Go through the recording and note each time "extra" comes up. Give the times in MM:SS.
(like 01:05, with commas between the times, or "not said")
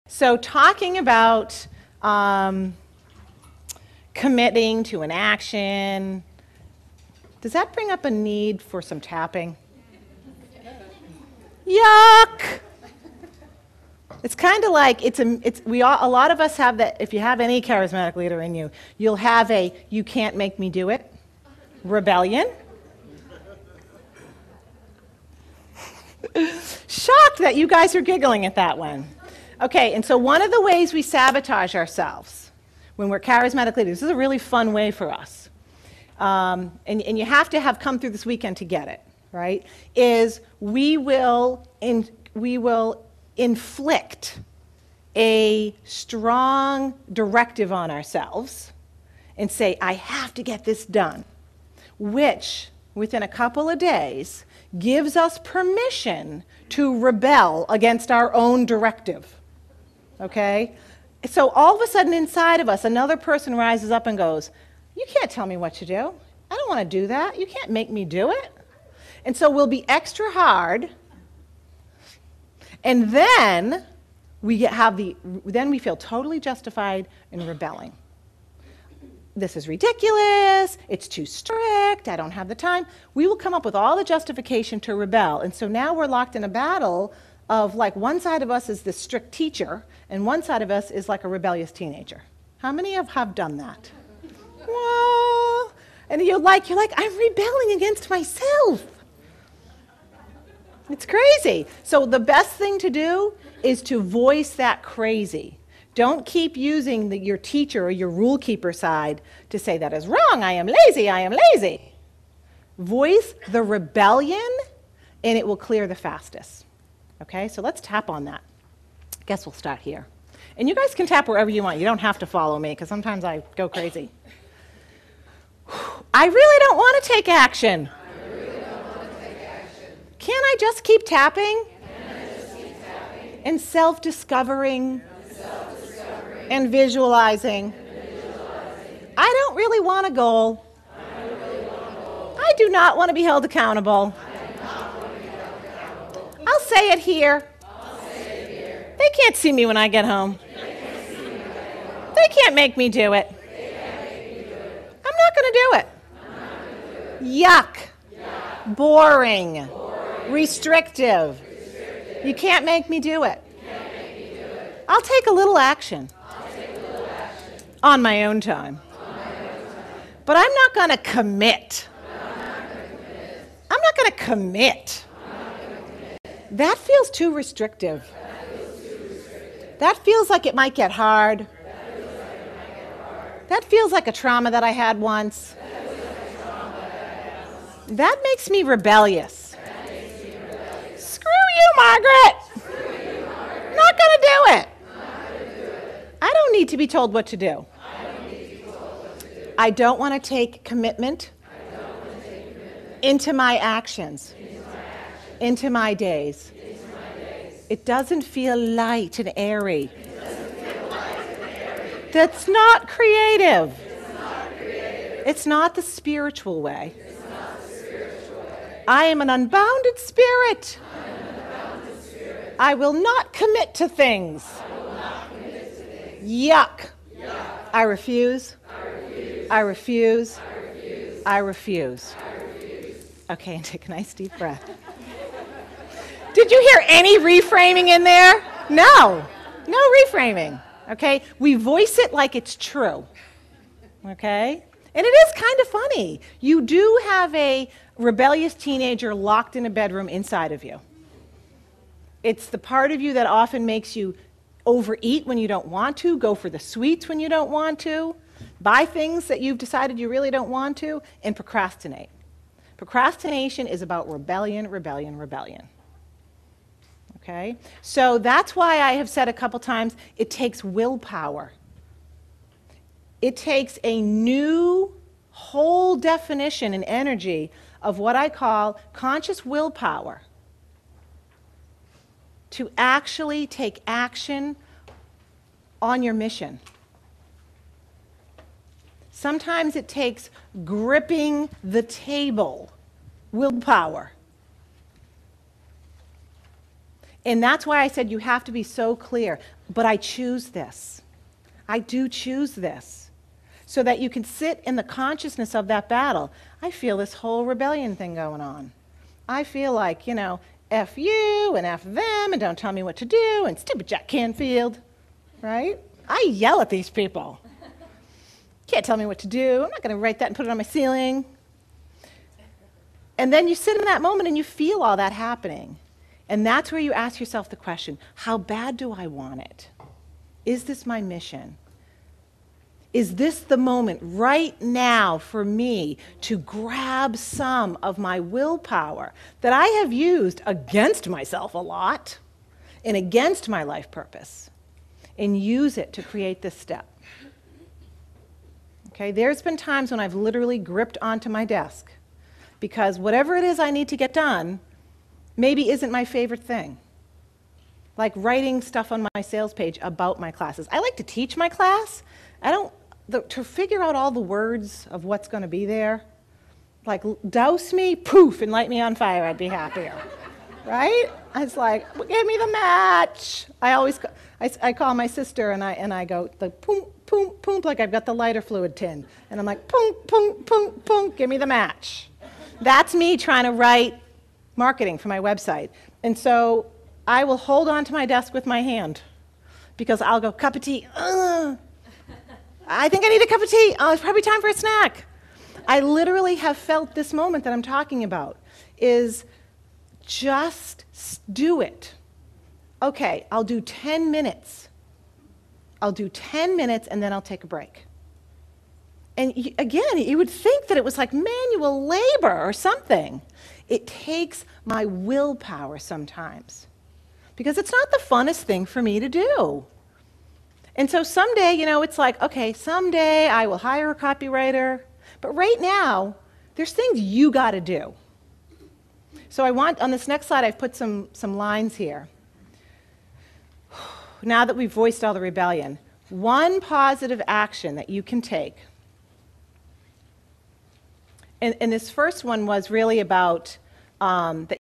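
01:09.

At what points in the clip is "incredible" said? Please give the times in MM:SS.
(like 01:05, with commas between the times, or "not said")
not said.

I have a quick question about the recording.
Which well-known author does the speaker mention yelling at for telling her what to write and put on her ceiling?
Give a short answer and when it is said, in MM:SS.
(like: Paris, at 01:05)
Jack Canfield, at 05:13.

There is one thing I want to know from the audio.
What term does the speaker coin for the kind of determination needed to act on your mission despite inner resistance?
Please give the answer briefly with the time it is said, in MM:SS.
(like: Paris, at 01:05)
conscious willpower, at 04:38.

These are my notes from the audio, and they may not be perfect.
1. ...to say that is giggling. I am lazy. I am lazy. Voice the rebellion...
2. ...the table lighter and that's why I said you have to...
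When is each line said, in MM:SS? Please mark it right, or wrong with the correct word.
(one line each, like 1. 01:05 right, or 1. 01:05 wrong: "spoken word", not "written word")
1. 01:49 wrong: "wrong", not "giggling"
2. 04:51 wrong: "willpower", not "lighter".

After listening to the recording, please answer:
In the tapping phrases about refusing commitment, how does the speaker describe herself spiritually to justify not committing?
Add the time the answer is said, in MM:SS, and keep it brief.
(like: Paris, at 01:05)
an unbounded spirit, at 03:39.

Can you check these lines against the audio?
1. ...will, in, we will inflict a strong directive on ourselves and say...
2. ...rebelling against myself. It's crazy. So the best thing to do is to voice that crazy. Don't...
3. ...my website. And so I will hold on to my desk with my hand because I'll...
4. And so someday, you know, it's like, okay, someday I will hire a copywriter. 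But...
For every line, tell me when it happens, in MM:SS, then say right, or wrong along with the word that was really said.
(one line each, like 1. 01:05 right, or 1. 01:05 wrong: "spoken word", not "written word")
1. 00:40 right
2. 01:37 right
3. 06:25 right
4. 07:00 right.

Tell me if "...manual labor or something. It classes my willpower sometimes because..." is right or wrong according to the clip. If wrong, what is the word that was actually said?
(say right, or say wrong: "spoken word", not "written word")
wrong: "takes", not "classes".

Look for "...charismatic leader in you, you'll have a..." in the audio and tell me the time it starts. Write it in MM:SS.
00:17.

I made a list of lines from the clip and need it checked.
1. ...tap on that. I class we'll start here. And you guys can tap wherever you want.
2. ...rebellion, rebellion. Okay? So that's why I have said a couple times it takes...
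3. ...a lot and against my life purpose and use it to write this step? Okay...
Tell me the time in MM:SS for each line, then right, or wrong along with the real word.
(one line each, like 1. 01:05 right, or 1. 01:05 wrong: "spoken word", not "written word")
1. 01:57 wrong: "guess", not "class"
2. 04:24 right
3. 05:41 wrong: "create", not "write".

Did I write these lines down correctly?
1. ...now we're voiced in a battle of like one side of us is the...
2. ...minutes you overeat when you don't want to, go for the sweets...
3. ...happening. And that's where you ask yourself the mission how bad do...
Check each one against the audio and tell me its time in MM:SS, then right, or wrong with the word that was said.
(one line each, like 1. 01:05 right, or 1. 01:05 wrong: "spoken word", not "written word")
1. 01:25 wrong: "locked", not "voiced"
2. 04:13 wrong: "makes", not "minutes"
3. 05:25 wrong: "question", not "mission".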